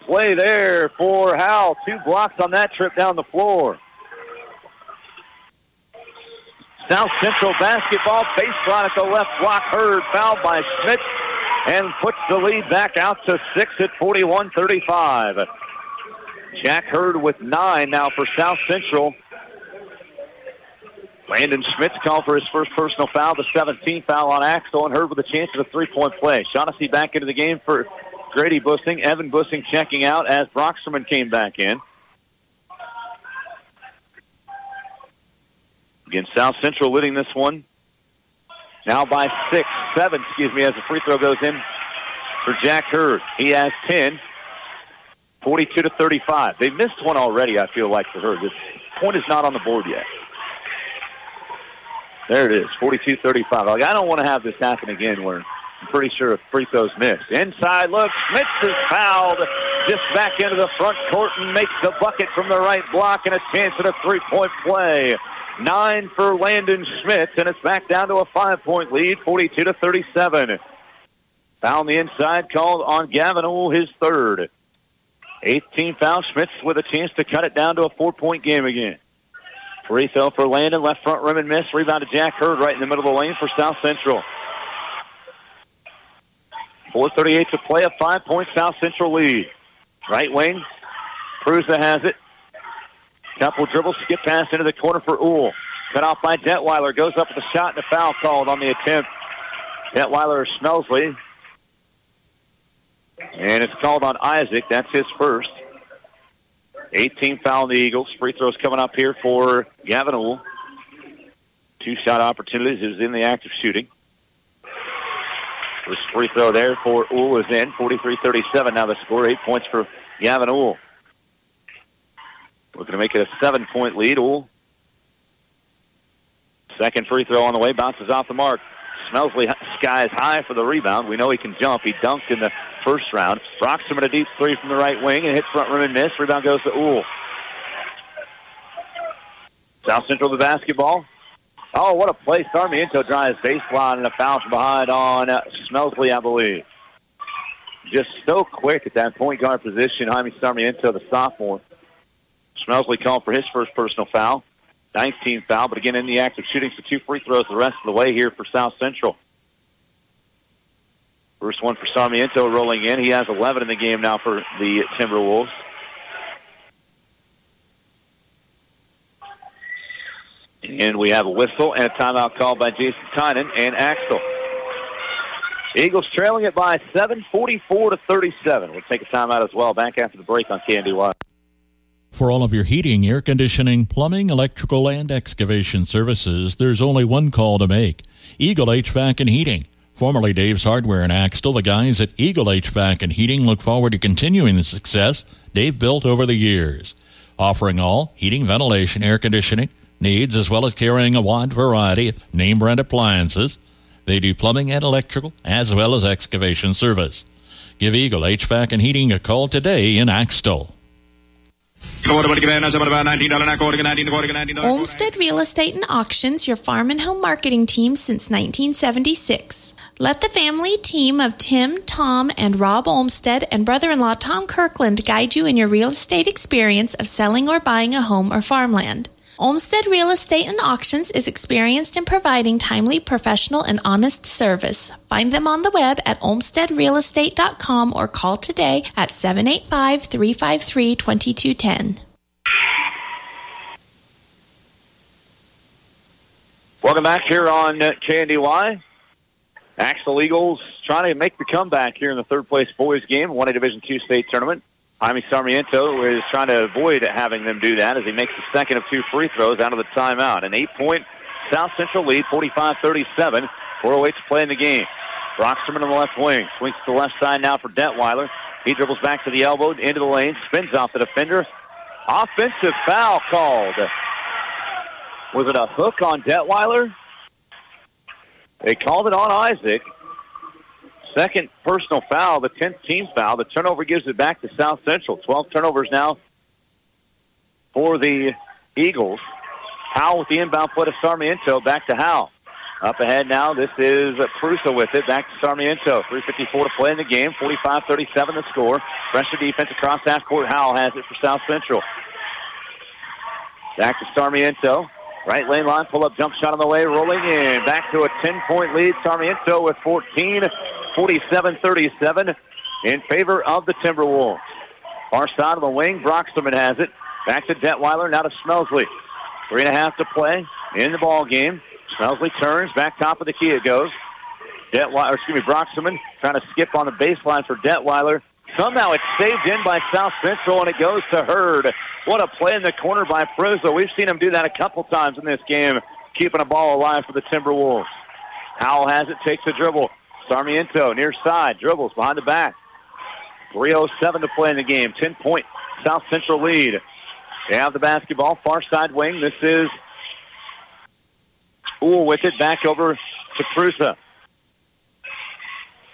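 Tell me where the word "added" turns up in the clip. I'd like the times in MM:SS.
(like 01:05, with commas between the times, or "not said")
not said.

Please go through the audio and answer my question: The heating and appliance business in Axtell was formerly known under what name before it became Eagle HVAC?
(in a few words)
Dave's Hardware.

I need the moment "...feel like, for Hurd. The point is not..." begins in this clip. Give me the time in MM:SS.
00:47.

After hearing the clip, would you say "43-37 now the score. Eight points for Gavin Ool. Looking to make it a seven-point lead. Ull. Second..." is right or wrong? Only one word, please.
right.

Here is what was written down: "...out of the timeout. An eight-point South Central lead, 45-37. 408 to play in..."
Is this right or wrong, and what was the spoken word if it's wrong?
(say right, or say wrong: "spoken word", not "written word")
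right.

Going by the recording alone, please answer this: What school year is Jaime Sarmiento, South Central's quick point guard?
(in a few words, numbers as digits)
Sophomore.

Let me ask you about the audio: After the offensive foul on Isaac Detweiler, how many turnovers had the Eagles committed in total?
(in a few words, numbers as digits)
12.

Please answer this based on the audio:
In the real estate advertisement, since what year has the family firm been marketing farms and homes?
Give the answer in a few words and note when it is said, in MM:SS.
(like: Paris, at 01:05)
1976, at 03:38.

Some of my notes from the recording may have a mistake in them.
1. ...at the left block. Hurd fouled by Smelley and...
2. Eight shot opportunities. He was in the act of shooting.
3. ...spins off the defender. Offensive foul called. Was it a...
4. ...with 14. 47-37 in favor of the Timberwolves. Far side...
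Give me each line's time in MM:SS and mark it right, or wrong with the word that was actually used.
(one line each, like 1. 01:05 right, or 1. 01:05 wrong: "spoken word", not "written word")
1. 00:08 wrong: "Smith", not "Smelley"
2. 01:51 wrong: "Two", not "Eight"
3. 04:30 right
4. 05:09 right.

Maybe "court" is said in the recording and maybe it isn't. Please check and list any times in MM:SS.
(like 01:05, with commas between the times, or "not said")
01:01, 05:00.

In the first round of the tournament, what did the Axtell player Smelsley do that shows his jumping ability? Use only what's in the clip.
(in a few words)
He dunked.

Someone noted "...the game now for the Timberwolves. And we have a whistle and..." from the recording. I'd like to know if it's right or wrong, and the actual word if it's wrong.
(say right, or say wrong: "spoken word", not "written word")
right.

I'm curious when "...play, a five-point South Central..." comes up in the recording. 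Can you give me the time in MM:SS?
01:27.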